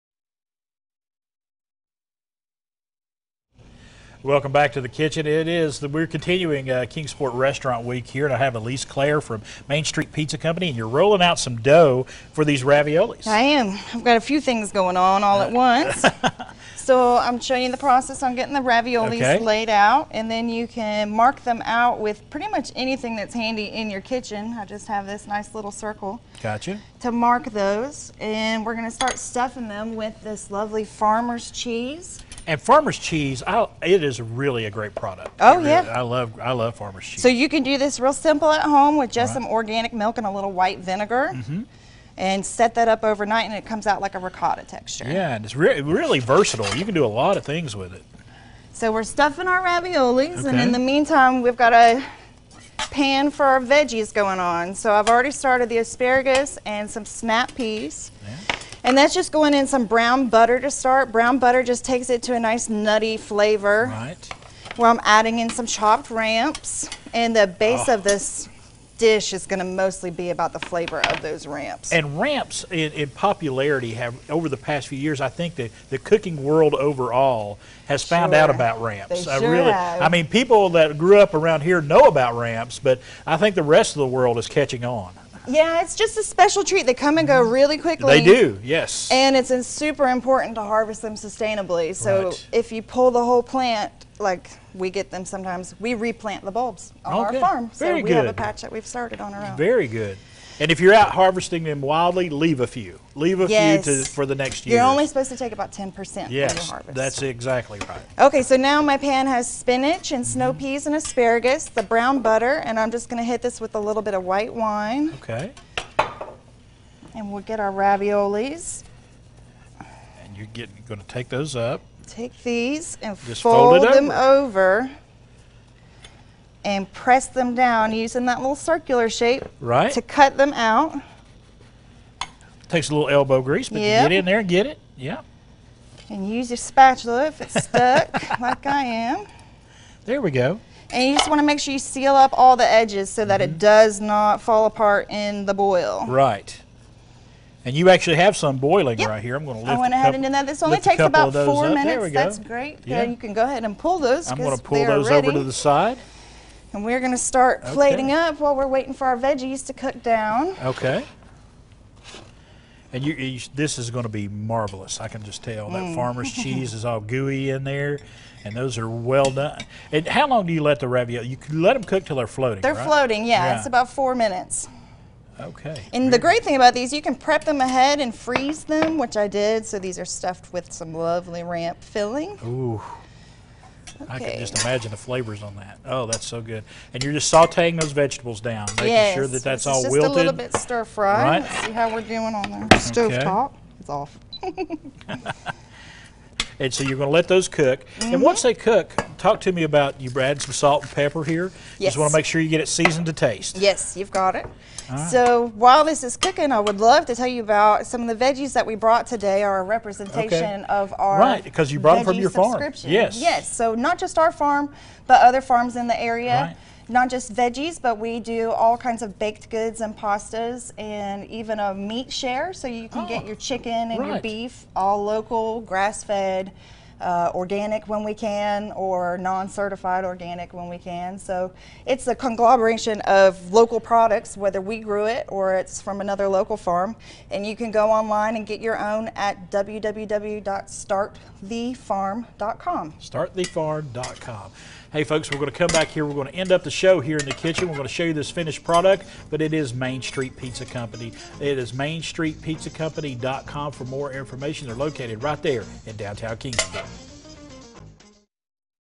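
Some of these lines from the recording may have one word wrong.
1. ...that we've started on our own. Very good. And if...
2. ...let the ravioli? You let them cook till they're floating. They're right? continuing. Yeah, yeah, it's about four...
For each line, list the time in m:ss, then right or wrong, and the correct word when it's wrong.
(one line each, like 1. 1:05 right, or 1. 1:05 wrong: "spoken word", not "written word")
1. 1:38 right
2. 2:50 wrong: "floating", not "continuing".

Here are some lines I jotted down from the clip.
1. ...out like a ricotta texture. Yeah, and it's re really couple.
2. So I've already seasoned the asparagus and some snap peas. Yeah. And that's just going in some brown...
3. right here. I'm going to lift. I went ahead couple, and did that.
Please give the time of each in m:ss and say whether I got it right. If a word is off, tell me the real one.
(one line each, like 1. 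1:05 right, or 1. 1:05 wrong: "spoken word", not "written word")
1. 0:43 wrong: "versatile", not "couple"
2. 0:54 wrong: "started", not "seasoned"
3. 2:29 right.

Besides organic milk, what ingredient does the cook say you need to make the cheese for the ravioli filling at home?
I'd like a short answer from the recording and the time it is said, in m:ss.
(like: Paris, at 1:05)
white vinegar, at 0:40.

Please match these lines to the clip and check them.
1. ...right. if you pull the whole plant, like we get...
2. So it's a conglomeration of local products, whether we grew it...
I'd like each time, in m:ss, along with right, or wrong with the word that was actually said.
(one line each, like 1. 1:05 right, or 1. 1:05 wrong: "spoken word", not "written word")
1. 1:32 right
2. 3:51 right.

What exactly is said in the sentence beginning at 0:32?
And farmer's cheese, I, it is really a great product.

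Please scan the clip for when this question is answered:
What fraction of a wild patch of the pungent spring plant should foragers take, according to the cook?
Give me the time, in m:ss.
1:45.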